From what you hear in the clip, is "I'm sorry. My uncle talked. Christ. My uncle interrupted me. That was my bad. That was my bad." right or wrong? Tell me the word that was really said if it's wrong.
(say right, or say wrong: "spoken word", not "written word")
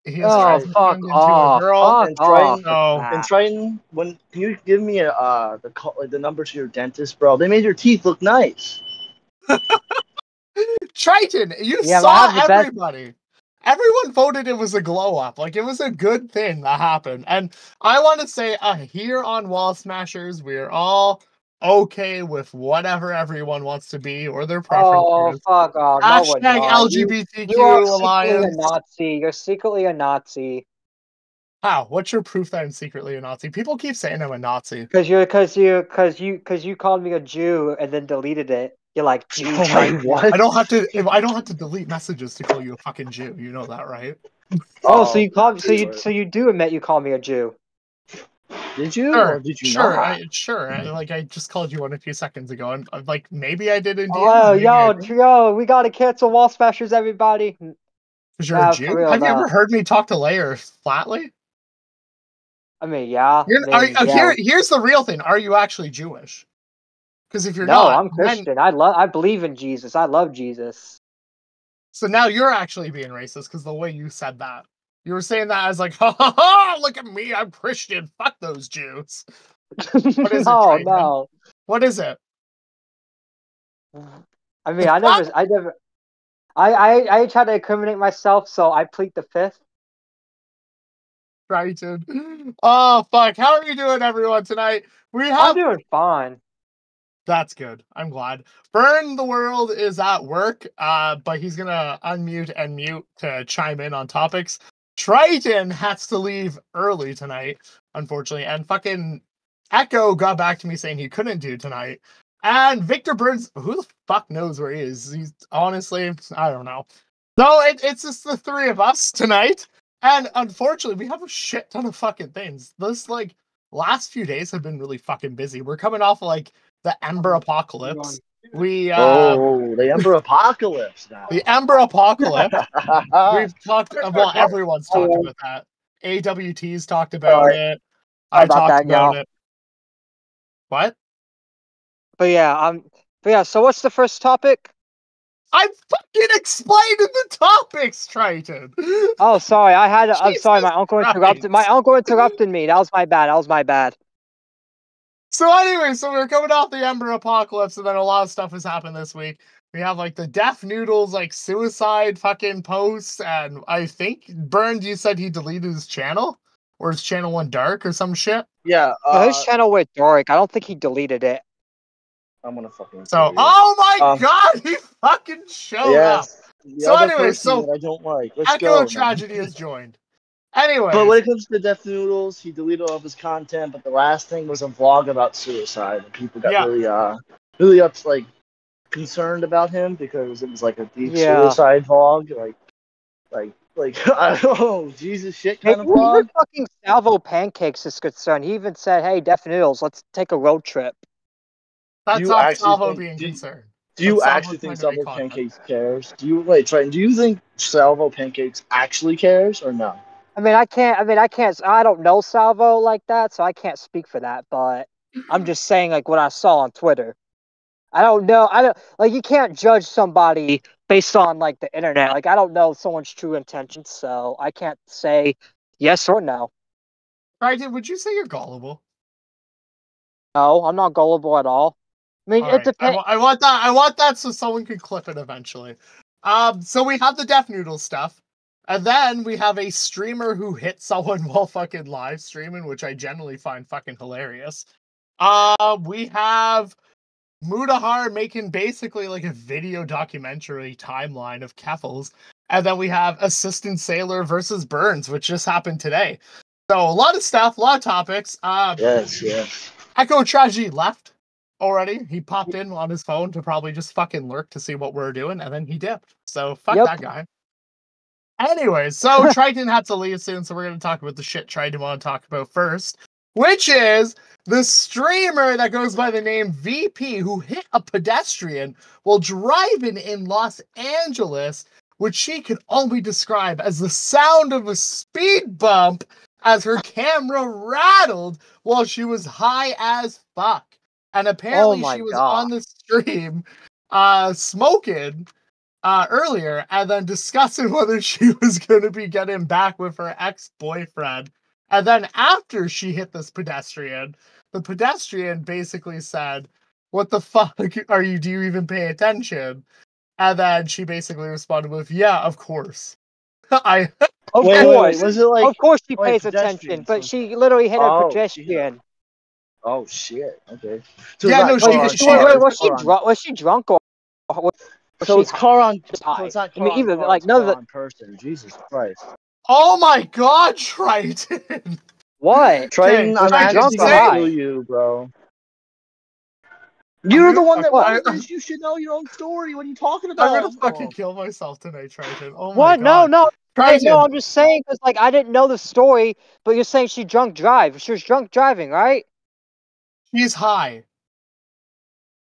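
wrong: "interrupted", not "talked".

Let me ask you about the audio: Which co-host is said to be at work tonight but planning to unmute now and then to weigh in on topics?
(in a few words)
Byrne the World.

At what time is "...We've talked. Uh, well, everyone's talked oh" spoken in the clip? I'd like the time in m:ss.
2:13.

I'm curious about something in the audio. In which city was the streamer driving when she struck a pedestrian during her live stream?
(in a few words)
Los Angeles.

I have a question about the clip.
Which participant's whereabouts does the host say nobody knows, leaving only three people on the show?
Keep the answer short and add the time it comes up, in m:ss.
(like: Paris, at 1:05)
Victor Burns, at 1:52.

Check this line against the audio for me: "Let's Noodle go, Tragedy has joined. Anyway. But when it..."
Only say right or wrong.
wrong.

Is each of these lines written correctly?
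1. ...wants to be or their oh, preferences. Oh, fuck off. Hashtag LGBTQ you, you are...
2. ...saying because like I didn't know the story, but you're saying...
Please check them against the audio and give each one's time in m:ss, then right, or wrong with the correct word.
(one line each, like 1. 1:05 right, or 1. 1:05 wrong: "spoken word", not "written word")
1. 0:23 right
2. 5:44 right.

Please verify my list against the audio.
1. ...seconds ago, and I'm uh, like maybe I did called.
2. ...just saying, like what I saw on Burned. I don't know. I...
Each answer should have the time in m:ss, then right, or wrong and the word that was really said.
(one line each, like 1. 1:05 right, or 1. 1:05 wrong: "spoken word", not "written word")
1. 0:52 wrong: "indeed", not "called"
2. 3:35 wrong: "Twitter", not "Burned".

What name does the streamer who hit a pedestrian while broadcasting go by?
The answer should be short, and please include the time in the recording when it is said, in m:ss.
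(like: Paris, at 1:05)
VP, at 4:36.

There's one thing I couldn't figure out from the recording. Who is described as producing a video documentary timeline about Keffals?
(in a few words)
Mudahar.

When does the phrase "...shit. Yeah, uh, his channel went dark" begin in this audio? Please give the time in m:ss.
2:48.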